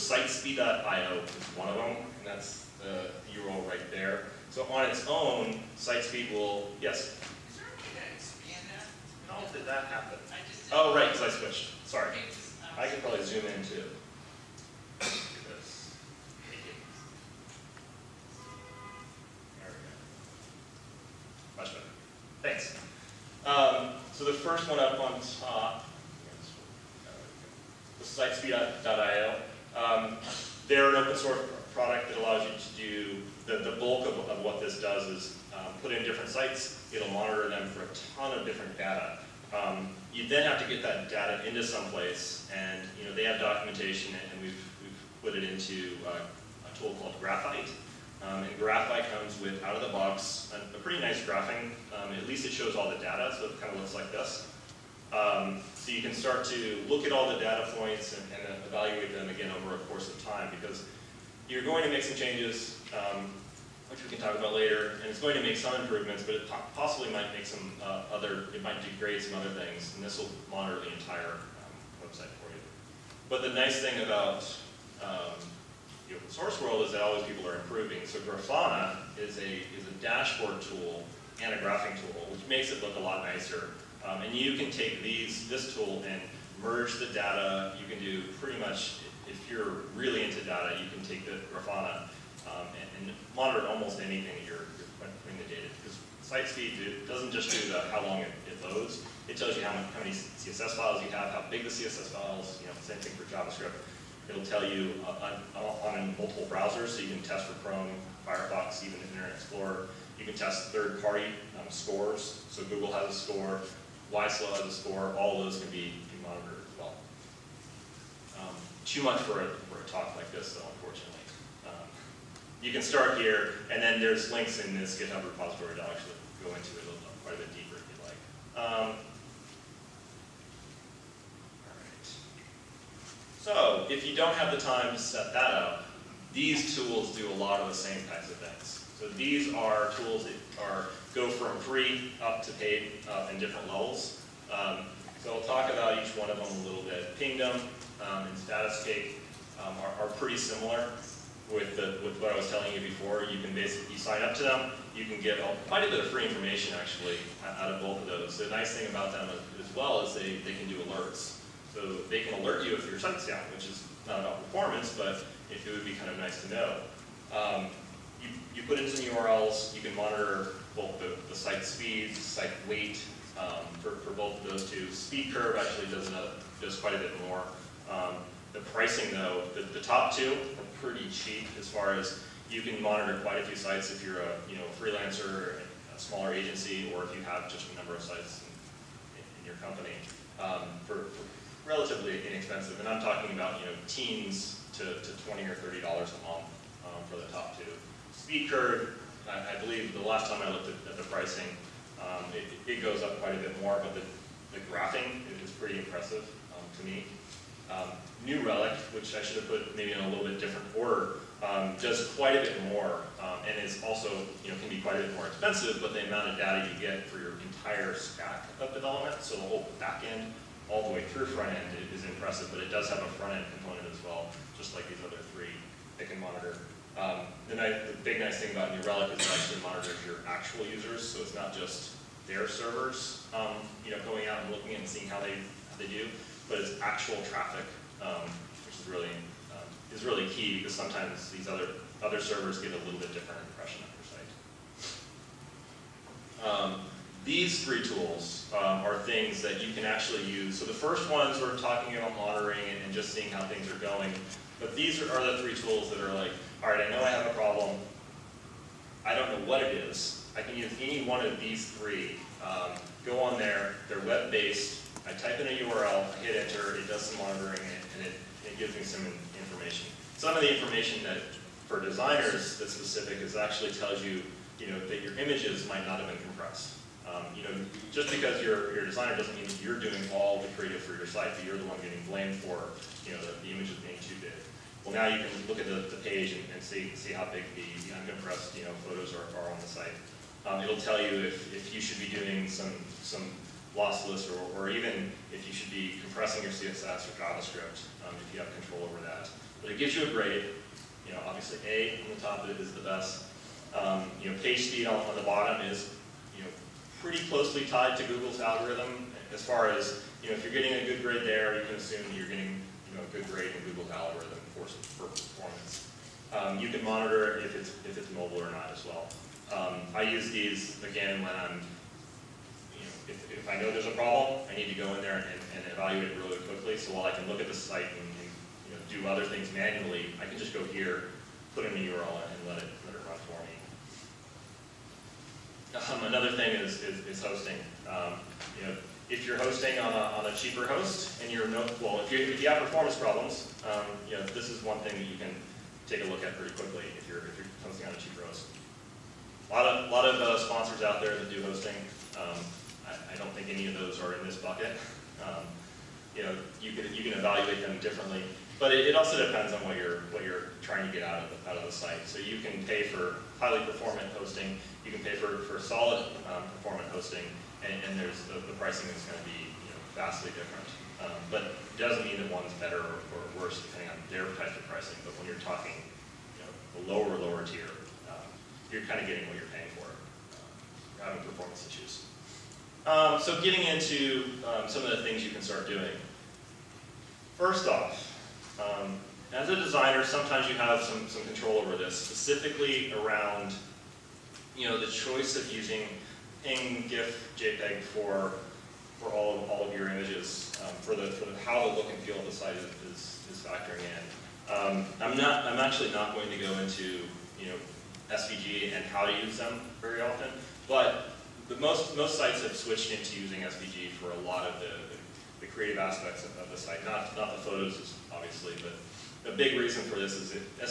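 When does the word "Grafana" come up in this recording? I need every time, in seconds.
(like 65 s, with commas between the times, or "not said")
78 s, 91 s.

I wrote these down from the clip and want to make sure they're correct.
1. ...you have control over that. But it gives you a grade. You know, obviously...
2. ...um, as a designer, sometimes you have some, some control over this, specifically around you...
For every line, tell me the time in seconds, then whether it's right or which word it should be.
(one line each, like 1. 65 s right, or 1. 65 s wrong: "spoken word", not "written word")
1. 298 s right
2. 388 s right.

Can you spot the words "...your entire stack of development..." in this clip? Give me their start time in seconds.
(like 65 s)
217 s.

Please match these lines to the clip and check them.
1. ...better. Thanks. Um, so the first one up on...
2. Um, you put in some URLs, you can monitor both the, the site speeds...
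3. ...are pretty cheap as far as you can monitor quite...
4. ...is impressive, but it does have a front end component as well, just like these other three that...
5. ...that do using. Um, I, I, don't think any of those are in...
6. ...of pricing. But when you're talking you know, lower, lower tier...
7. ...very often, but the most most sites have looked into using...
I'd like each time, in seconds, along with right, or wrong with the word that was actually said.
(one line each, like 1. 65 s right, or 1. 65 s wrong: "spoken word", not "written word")
1. 21 s right
2. 167 s right
3. 180 s right
4. 221 s right
5. 351 s wrong: "hosting", not "using"
6. 374 s right
7. 409 s wrong: "switched", not "looked".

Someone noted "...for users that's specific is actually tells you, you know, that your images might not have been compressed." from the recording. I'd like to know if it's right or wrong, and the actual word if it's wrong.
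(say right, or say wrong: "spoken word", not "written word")
wrong: "designers", not "users".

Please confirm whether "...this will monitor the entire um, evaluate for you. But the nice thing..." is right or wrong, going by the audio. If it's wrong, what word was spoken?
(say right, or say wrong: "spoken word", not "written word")
wrong: "website", not "evaluate".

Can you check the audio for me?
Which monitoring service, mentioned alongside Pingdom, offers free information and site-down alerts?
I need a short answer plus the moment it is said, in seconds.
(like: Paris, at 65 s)
Statuscake, at 148 s.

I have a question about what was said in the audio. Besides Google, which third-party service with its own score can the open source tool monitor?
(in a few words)
YSlow.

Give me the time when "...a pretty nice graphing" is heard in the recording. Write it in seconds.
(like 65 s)
50 s.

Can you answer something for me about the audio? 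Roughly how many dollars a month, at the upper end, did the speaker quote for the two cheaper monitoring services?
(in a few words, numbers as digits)
30.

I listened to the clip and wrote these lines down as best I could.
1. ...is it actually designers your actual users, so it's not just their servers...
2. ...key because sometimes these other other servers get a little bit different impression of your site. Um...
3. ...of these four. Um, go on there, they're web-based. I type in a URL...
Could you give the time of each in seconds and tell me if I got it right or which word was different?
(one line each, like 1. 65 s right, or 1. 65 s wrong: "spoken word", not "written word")
1. 229 s wrong: "monitors", not "designers"
2. 240 s right
3. 261 s wrong: "three", not "four".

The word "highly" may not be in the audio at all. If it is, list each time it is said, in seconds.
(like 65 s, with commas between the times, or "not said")
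363 s.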